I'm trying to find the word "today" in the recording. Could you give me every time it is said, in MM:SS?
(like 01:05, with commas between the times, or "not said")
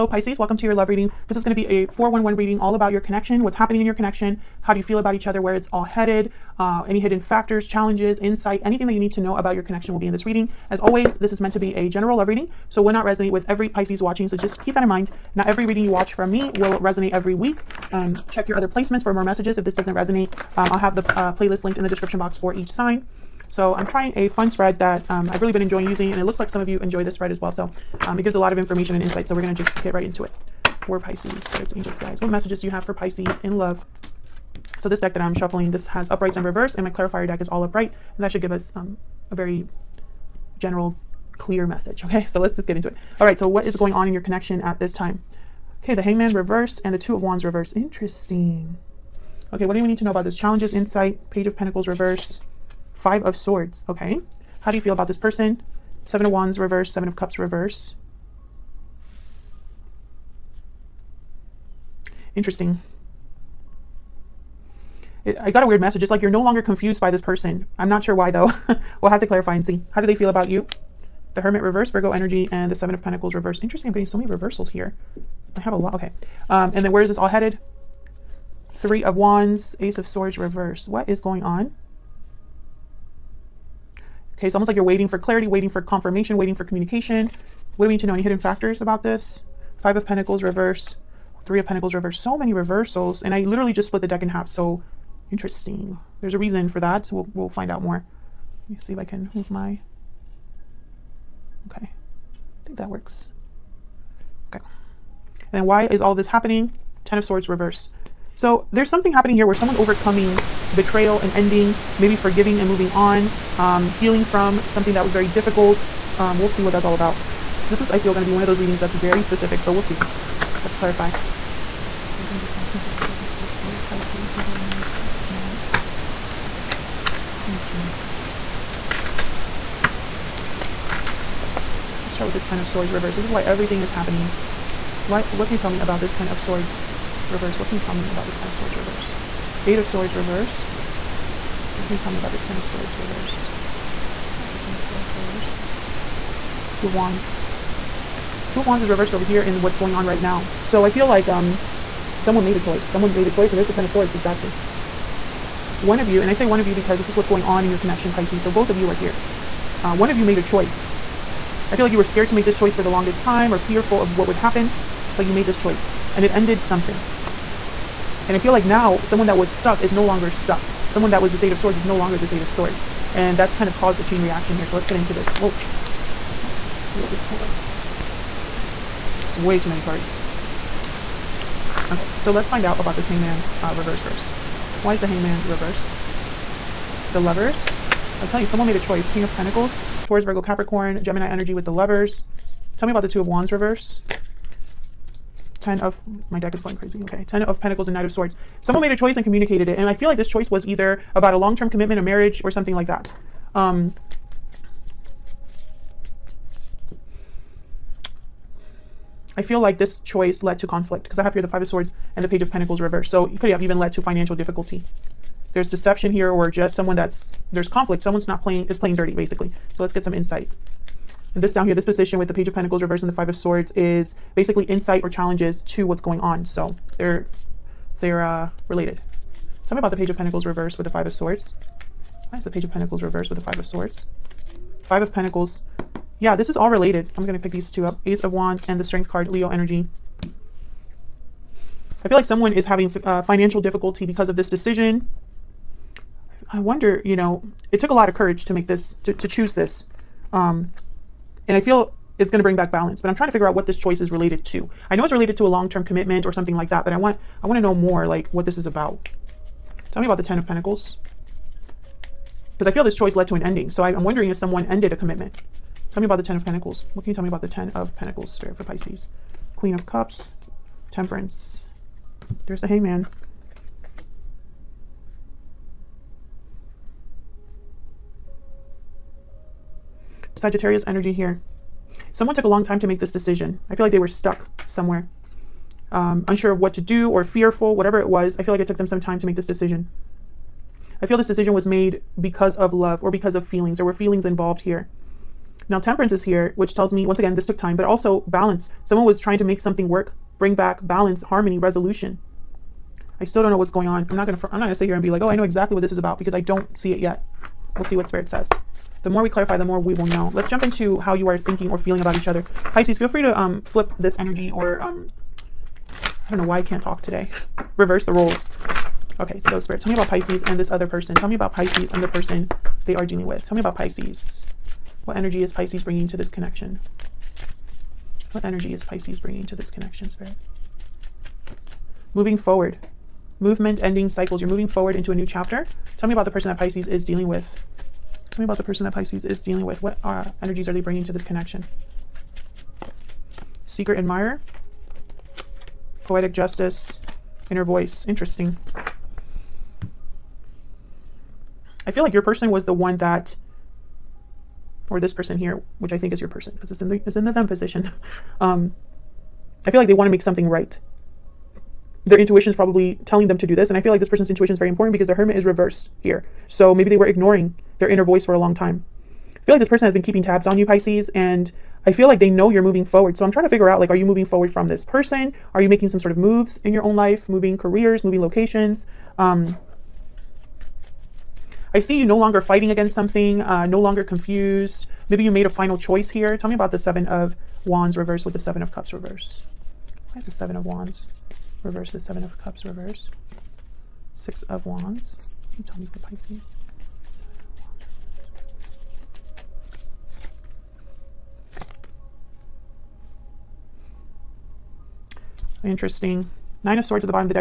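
05:17.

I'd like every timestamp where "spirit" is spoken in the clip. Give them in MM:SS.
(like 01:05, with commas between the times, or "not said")
00:31, 02:02, 04:28, 05:08, 05:19, 05:30.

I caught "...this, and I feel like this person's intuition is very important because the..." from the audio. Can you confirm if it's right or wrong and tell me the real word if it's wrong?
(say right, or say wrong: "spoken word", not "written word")
right.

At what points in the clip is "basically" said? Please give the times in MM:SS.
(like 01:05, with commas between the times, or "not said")
03:39, 03:44.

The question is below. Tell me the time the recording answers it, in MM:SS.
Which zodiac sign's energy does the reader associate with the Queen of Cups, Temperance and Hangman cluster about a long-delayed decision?
04:40.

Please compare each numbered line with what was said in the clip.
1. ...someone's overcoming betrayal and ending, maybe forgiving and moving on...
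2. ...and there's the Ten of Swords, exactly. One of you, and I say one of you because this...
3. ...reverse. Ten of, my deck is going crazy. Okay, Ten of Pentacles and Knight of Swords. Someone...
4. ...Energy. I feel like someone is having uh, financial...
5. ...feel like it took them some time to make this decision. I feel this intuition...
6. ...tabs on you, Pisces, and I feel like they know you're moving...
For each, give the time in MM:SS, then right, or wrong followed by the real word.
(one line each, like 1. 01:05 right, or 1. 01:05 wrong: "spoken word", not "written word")
1. 01:49 right
2. 02:33 right
3. 03:13 right
4. 03:59 right
5. 04:48 wrong: "decision", not "intuition"
6. 06:10 right.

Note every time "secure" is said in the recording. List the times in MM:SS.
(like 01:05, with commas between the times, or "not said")
not said.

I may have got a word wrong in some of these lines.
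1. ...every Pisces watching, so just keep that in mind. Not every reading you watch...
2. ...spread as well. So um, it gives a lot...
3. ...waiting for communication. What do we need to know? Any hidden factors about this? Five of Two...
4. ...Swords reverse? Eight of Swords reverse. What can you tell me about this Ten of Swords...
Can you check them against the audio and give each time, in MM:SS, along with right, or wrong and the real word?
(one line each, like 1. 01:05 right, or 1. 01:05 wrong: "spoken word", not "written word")
1. 00:13 right
2. 00:27 right
3. 01:26 wrong: "Pentacles", not "Two"
4. 02:18 right.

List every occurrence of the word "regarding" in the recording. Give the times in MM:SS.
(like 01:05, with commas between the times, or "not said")
02:04.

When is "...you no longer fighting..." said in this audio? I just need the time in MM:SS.
06:21.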